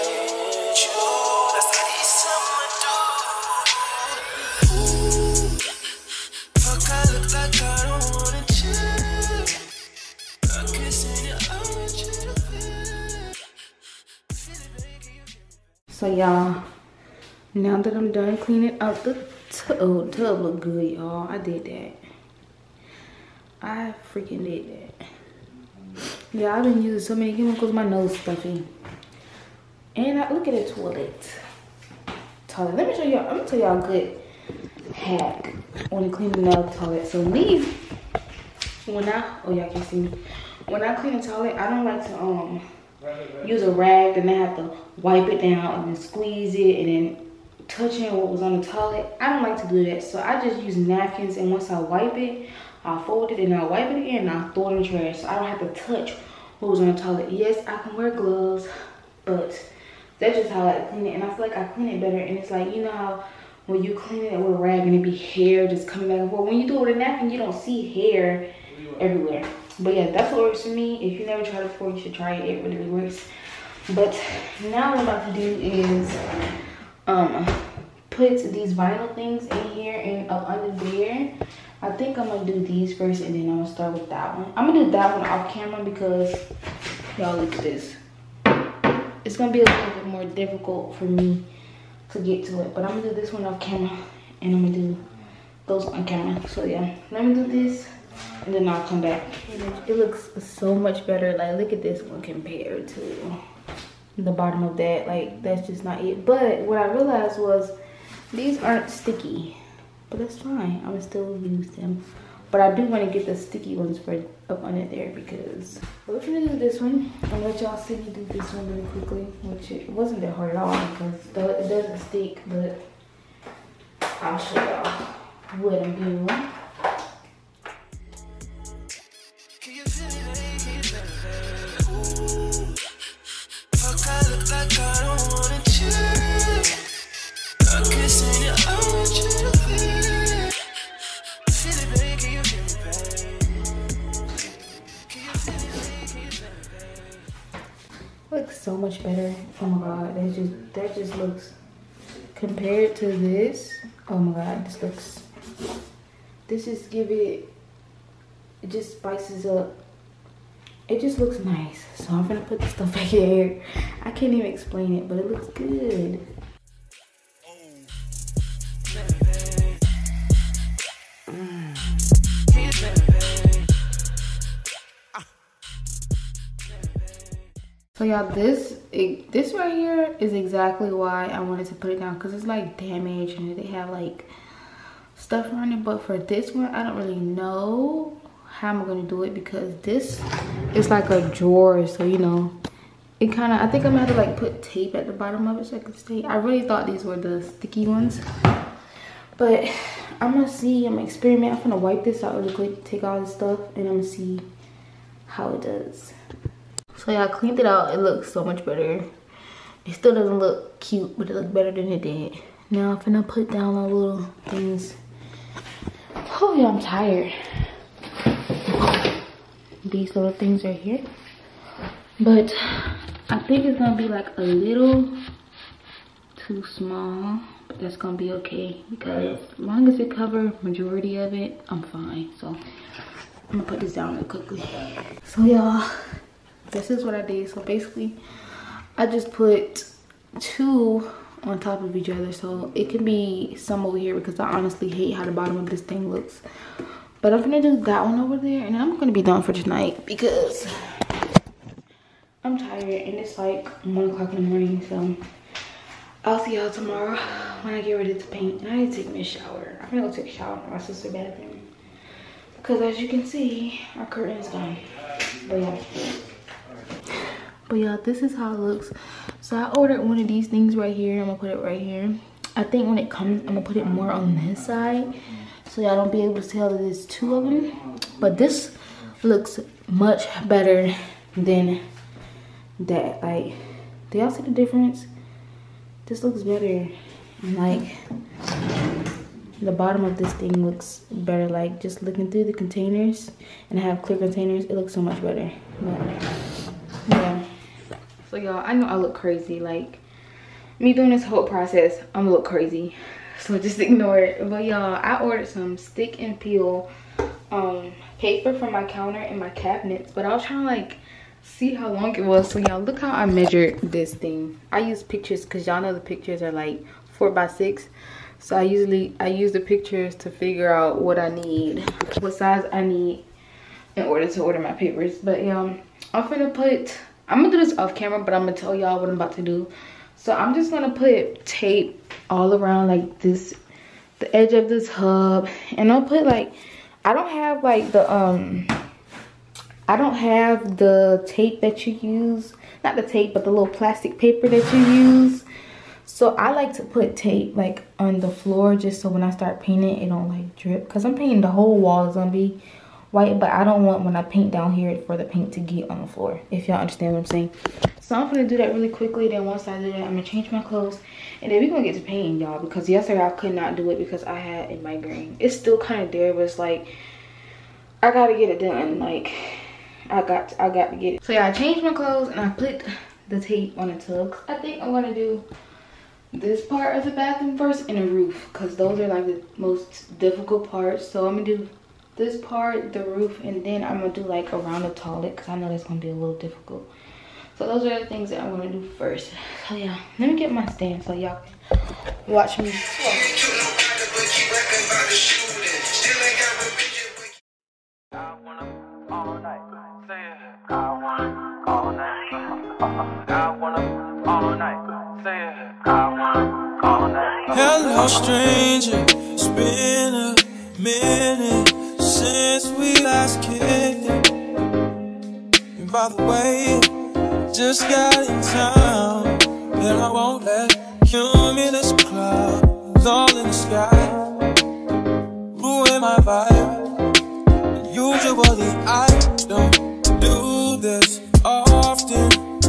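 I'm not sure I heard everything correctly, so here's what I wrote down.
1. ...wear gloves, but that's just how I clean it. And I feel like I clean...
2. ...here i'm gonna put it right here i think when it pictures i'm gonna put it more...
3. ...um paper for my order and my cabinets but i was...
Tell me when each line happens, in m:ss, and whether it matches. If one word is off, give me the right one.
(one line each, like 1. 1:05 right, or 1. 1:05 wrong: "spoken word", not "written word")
1. 0:57 right
2. 4:30 wrong: "comes", not "pictures"
3. 5:07 wrong: "counter", not "order".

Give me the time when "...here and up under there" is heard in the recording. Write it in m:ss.
1:19.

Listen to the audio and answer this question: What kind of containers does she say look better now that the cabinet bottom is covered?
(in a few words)
Clear containers.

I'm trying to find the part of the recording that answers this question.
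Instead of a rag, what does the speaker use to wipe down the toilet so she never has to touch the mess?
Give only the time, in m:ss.
0:50.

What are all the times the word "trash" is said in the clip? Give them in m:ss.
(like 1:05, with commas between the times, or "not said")
0:54.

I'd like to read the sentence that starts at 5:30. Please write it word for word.
So I'm just gonna put tape all around like this, the edge of this hub.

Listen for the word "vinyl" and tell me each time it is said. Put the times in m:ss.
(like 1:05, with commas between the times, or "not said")
1:18.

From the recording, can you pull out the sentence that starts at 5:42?
Not the tape, but the little plastic paper that you use.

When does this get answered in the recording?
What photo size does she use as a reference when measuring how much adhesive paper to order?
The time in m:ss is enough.
5:17.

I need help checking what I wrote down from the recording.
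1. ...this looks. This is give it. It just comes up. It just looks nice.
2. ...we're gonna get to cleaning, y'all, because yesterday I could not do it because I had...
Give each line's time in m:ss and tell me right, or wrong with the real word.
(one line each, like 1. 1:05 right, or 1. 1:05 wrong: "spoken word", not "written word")
1. 2:34 wrong: "spices", not "comes"
2. 6:01 wrong: "painting", not "cleaning".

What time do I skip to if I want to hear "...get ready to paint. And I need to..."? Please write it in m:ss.
4:17.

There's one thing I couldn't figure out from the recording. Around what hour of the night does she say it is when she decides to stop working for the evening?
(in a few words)
1 o'clock.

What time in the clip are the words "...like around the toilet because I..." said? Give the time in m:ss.
6:24.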